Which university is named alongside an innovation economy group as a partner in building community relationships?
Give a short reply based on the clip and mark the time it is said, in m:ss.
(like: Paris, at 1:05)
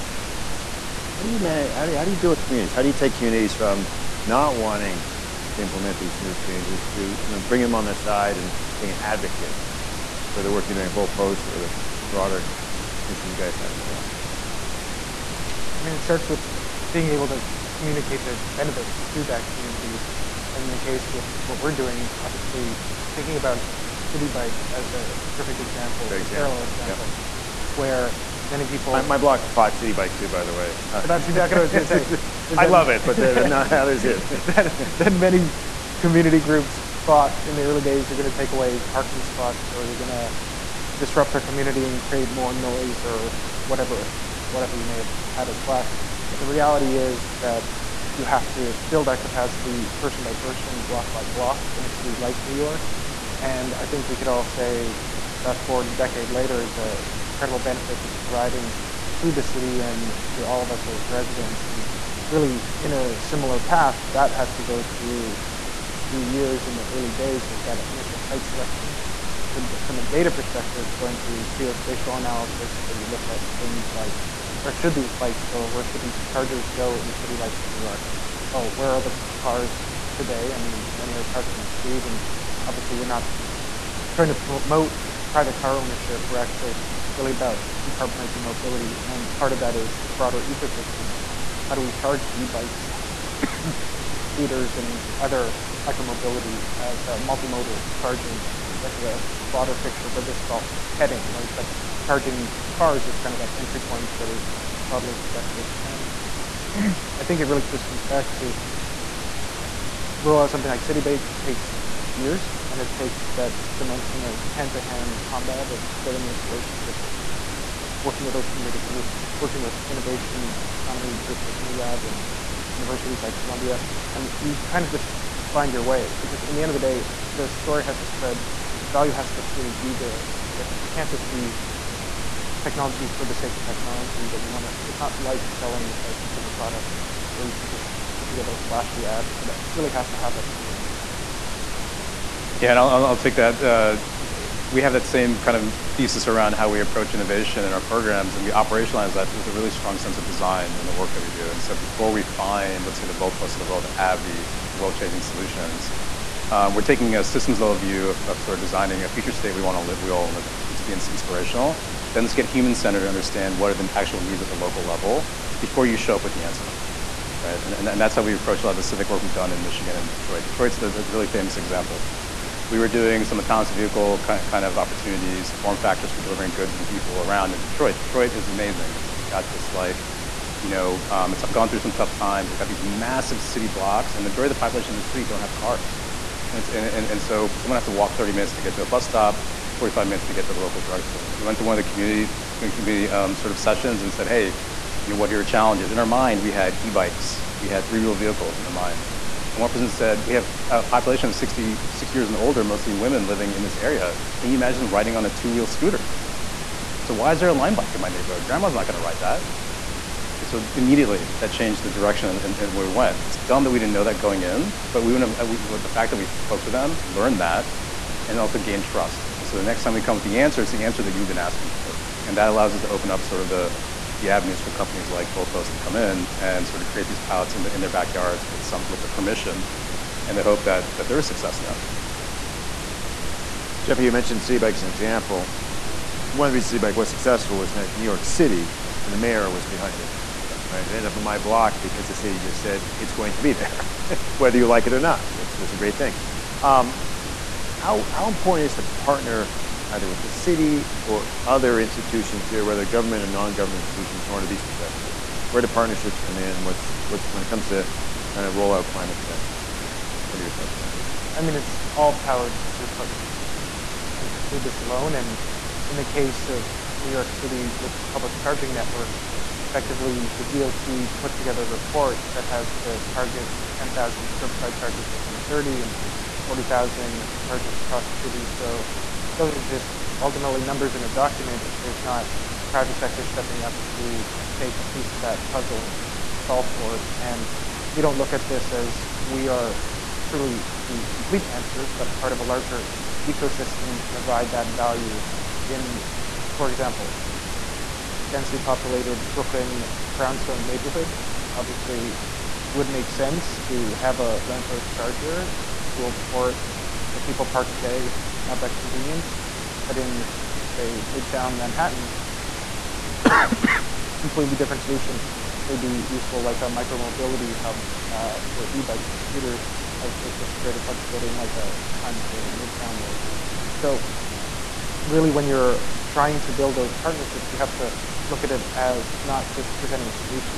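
Columbia, at 2:03.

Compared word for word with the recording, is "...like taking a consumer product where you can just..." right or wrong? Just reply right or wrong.
wrong.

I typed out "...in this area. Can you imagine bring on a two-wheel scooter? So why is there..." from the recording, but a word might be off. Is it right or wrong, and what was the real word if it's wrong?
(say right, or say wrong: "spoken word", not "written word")
wrong: "riding", not "bring".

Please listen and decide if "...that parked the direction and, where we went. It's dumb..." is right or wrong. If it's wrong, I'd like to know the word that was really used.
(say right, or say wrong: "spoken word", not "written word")
wrong: "changed", not "parked".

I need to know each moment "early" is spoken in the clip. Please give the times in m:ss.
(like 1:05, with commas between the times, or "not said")
0:37, 1:06.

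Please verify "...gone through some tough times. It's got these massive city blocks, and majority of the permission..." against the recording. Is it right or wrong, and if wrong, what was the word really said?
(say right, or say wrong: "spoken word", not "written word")
wrong: "population", not "permission".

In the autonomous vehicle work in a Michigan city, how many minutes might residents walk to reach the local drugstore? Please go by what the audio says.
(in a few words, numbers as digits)
45.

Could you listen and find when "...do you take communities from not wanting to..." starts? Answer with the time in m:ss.
0:02.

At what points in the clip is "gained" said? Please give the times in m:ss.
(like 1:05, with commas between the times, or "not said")
3:38.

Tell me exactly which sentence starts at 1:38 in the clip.
as the broader picture of where this is all heading, right?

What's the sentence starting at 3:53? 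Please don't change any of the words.
Jeffrey, you mentioned Bike as an example.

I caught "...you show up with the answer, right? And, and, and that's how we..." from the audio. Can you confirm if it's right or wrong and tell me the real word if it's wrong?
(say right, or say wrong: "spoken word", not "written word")
right.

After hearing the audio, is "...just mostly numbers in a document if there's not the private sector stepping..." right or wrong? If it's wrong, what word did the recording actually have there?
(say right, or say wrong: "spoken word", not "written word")
wrong: "ultimately", not "mostly".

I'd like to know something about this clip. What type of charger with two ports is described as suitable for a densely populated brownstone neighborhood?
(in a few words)
lamppost charger.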